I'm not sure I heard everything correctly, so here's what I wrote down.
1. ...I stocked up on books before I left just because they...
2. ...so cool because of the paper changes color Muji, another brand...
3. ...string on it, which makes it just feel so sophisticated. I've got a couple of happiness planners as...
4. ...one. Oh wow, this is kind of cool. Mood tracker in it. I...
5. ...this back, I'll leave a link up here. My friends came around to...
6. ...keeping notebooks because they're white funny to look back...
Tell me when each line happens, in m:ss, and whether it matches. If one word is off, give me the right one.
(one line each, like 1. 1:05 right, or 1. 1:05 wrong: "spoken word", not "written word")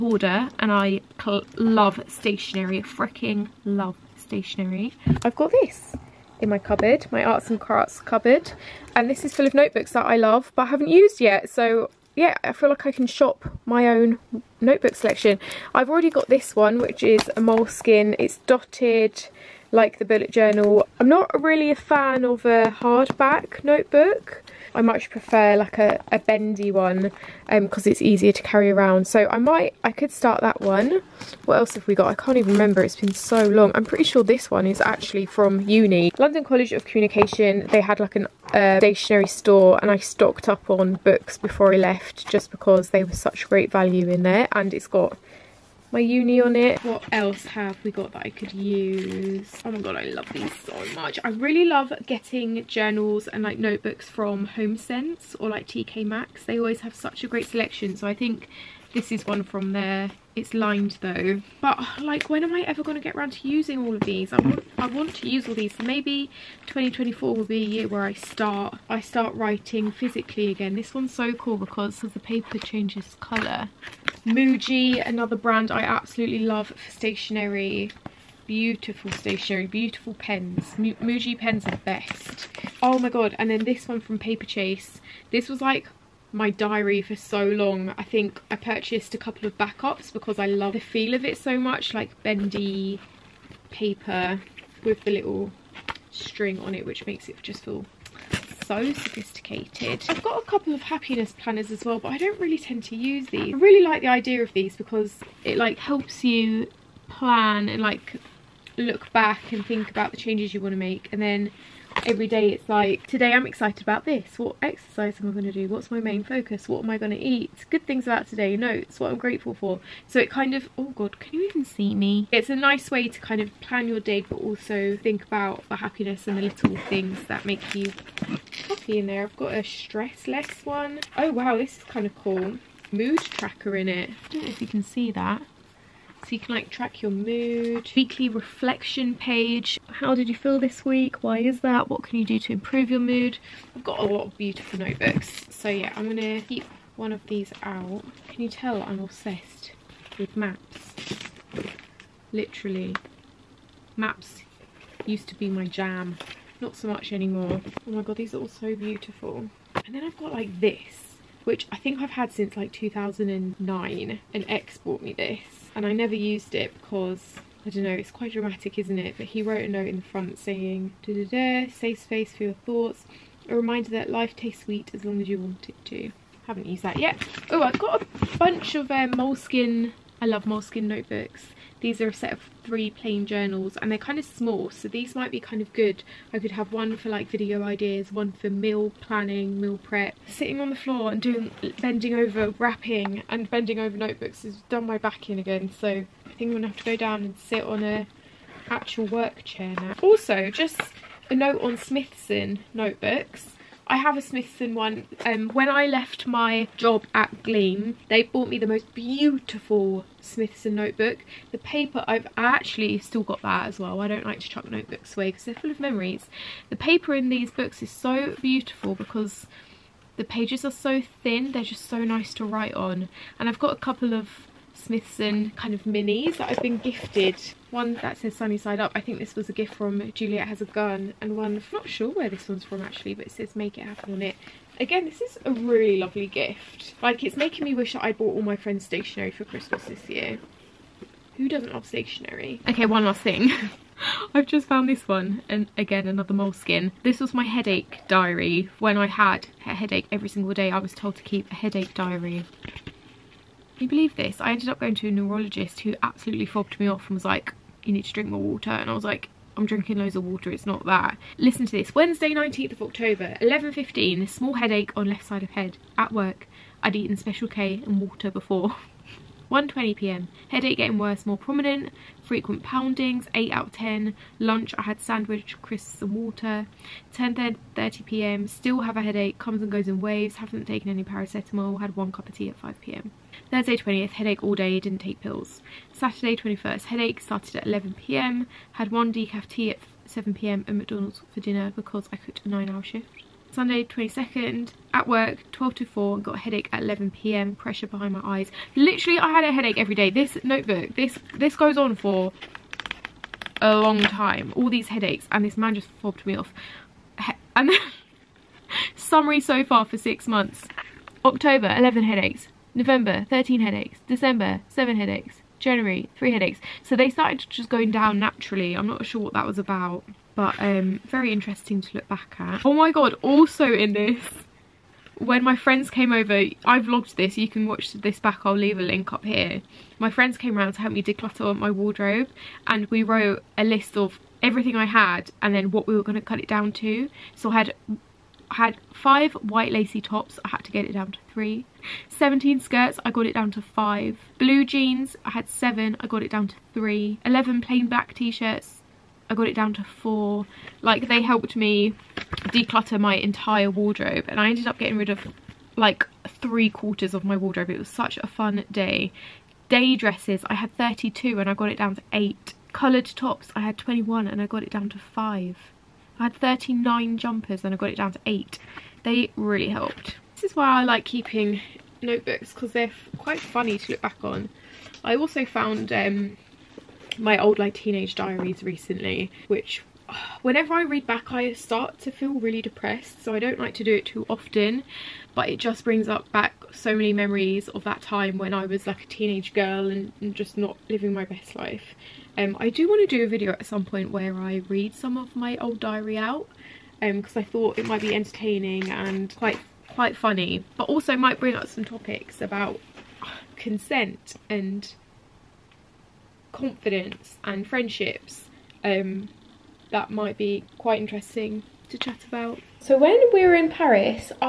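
1. 0:39 right
2. 1:11 right
3. 1:36 right
4. 2:10 right
5. 5:27 right
6. 6:11 wrong: "quite", not "white".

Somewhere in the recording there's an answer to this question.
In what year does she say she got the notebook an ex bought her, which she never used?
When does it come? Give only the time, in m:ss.
2:42.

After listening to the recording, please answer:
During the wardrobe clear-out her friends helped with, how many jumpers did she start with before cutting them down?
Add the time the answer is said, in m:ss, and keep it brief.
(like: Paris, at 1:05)
39, at 6:06.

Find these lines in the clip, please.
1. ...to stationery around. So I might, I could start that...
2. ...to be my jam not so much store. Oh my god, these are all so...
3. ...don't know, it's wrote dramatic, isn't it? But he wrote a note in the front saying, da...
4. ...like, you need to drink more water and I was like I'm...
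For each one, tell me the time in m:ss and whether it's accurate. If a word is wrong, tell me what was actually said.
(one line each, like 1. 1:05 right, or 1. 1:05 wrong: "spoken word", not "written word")
1. 0:28 wrong: "carry", not "stationery"
2. 2:35 wrong: "anymore", not "store"
3. 2:47 wrong: "quite", not "wrote"
4. 4:17 right.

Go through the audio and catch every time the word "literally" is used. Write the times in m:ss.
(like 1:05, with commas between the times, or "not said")
2:32, 4:58.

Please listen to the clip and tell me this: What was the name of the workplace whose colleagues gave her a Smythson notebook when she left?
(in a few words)
Gleam.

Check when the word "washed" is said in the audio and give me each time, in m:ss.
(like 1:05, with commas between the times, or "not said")
not said.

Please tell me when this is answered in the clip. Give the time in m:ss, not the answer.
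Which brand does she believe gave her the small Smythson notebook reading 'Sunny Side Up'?
3:50.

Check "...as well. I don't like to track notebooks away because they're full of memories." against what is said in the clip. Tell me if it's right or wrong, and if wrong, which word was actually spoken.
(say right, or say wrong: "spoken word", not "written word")
wrong: "chuck", not "track".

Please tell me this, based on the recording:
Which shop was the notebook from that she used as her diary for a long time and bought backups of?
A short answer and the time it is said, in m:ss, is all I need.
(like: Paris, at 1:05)
Paperchase, at 1:24.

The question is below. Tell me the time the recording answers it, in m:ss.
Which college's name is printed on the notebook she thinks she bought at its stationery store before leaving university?
0:36.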